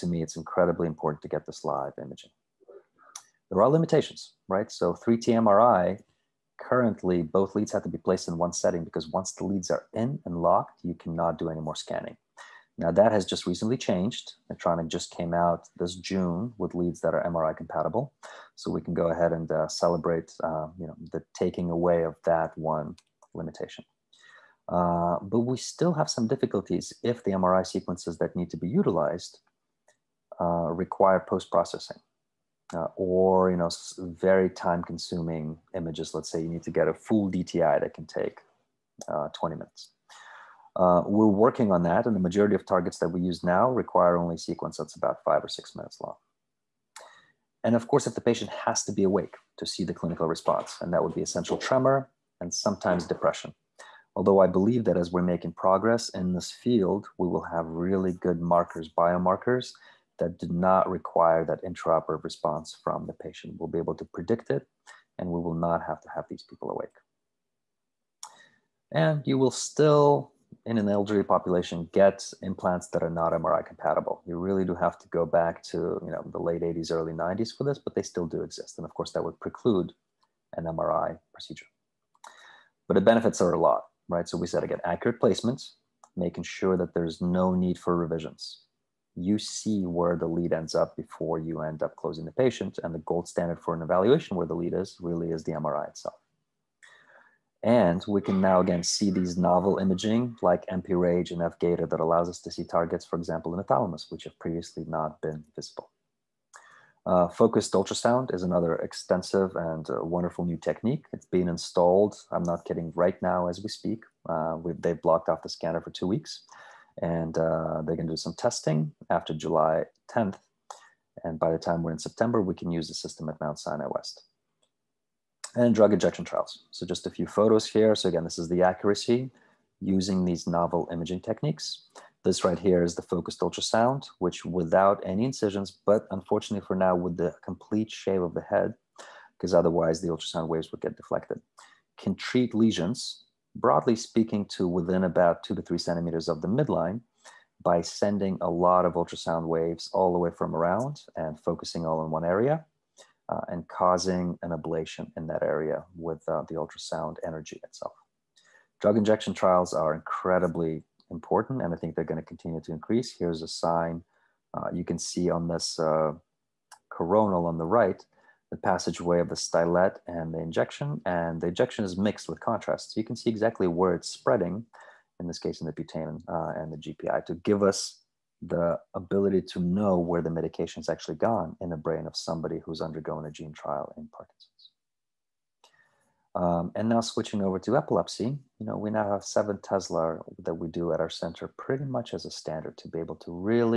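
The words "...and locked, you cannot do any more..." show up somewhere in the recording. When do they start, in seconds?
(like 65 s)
10 s.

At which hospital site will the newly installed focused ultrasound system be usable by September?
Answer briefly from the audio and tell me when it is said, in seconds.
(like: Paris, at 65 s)
Mount Sinai West, at 123 s.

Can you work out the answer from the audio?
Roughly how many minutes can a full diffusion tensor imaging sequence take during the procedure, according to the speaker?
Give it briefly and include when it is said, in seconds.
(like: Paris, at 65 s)
20 minutes, at 39 s.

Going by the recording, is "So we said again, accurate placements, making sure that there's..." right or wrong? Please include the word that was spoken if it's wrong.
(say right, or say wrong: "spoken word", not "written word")
right.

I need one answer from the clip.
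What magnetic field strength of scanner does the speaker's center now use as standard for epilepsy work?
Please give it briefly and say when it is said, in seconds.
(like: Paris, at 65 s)
7 Tesla, at 189 s.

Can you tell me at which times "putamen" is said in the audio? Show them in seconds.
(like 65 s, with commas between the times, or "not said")
175 s.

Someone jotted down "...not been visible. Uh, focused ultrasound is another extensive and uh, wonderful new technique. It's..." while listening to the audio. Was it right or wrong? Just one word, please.
right.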